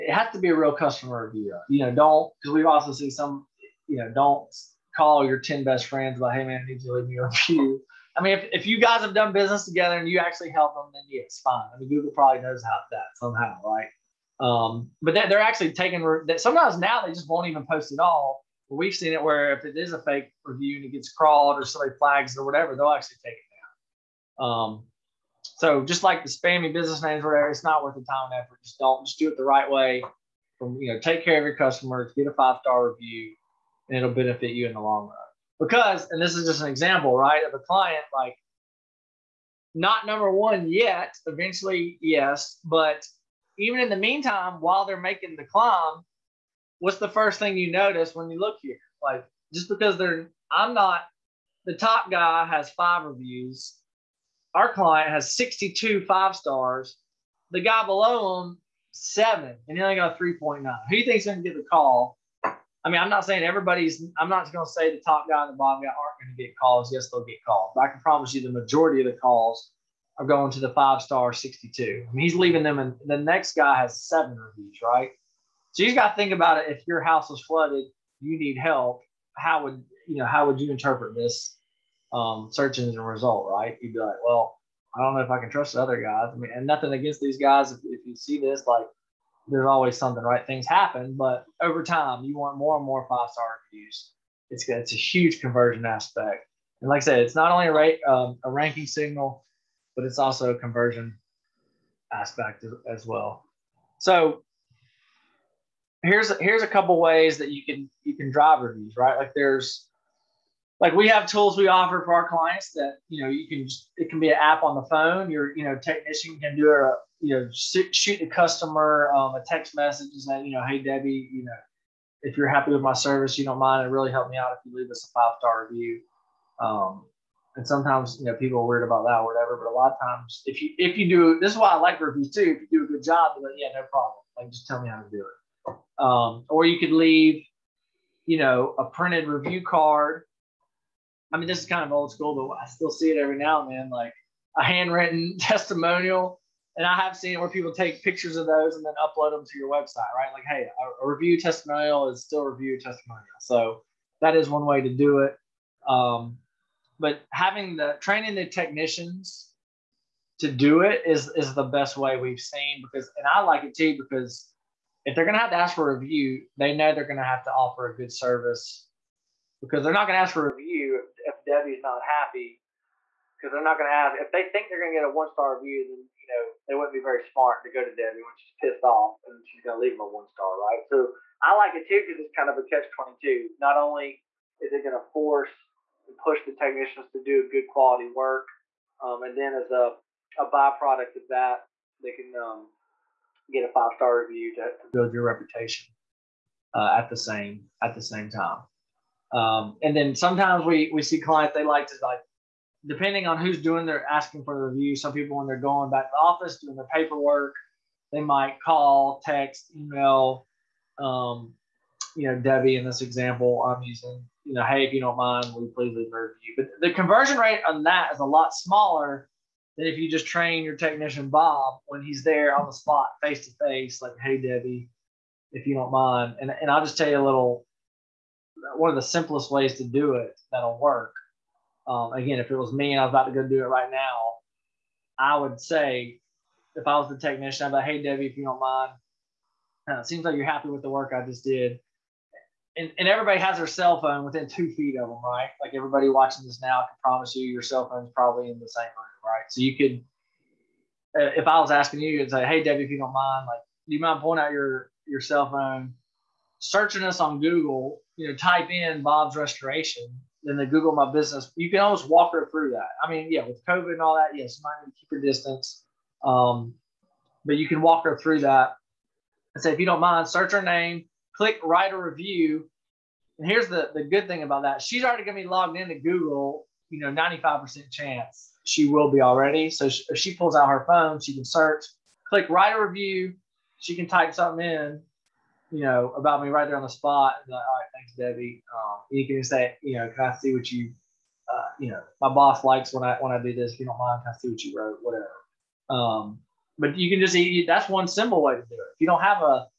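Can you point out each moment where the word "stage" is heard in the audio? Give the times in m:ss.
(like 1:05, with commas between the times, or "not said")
not said.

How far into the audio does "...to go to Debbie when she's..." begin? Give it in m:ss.
2:57.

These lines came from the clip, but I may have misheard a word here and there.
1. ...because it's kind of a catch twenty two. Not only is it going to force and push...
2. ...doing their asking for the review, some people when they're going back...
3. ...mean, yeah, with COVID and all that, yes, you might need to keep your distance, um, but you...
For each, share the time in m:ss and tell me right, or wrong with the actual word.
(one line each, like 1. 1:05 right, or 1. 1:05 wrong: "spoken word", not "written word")
1. 3:02 right
2. 3:23 right
3. 4:23 right.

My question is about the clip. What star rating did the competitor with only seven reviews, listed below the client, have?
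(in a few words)
3.9.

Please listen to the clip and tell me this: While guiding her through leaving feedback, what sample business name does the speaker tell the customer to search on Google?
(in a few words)
Bob's Restoration.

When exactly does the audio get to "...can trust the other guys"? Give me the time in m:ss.
1:25.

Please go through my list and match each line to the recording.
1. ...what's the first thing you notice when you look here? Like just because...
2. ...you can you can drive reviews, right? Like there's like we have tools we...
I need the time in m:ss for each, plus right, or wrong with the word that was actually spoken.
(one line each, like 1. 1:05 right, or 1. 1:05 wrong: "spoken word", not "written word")
1. 0:46 right
2. 1:47 right.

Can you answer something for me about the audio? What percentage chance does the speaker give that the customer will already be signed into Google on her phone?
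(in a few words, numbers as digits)
95%.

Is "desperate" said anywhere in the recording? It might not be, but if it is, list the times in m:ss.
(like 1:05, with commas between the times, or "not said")
not said.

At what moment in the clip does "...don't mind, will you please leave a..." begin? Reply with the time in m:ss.
3:34.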